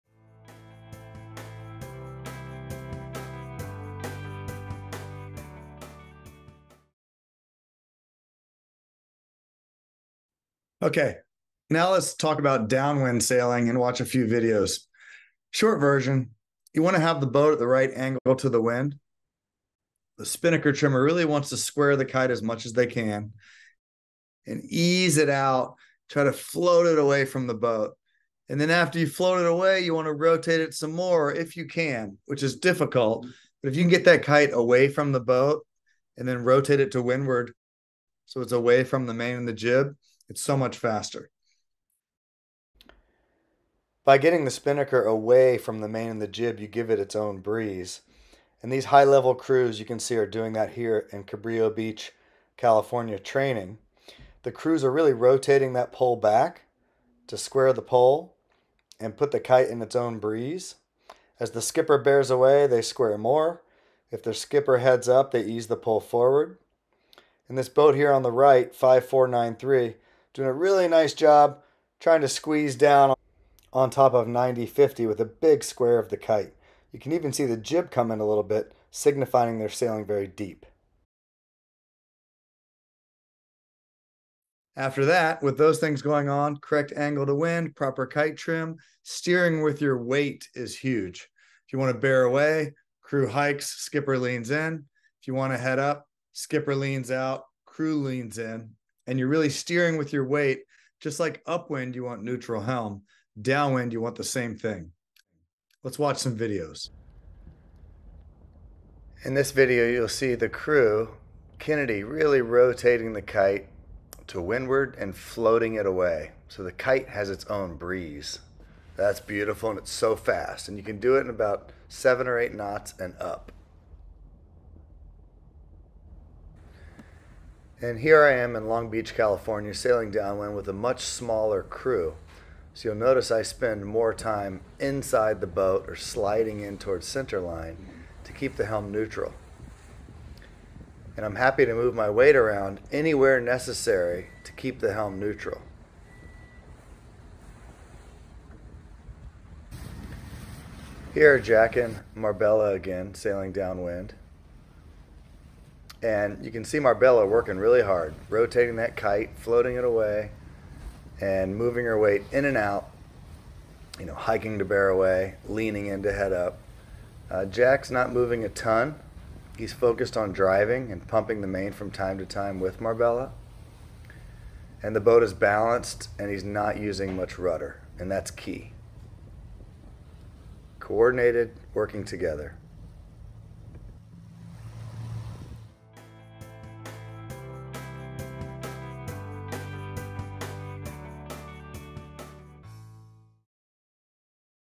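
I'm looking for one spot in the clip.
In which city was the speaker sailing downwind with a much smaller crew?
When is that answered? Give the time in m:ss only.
2:08.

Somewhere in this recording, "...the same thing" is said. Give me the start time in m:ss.
1:44.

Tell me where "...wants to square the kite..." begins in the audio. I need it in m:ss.
0:21.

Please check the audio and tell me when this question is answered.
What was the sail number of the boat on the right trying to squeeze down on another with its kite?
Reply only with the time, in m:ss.
1:08.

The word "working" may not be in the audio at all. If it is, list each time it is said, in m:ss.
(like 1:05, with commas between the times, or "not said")
2:37, 3:01.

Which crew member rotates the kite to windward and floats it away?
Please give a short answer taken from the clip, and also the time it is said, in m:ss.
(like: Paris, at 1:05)
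Kennedy, at 1:51.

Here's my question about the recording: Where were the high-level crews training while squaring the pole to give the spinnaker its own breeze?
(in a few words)
Cabrillo Beach, California.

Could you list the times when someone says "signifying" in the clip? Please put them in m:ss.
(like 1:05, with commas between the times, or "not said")
1:18.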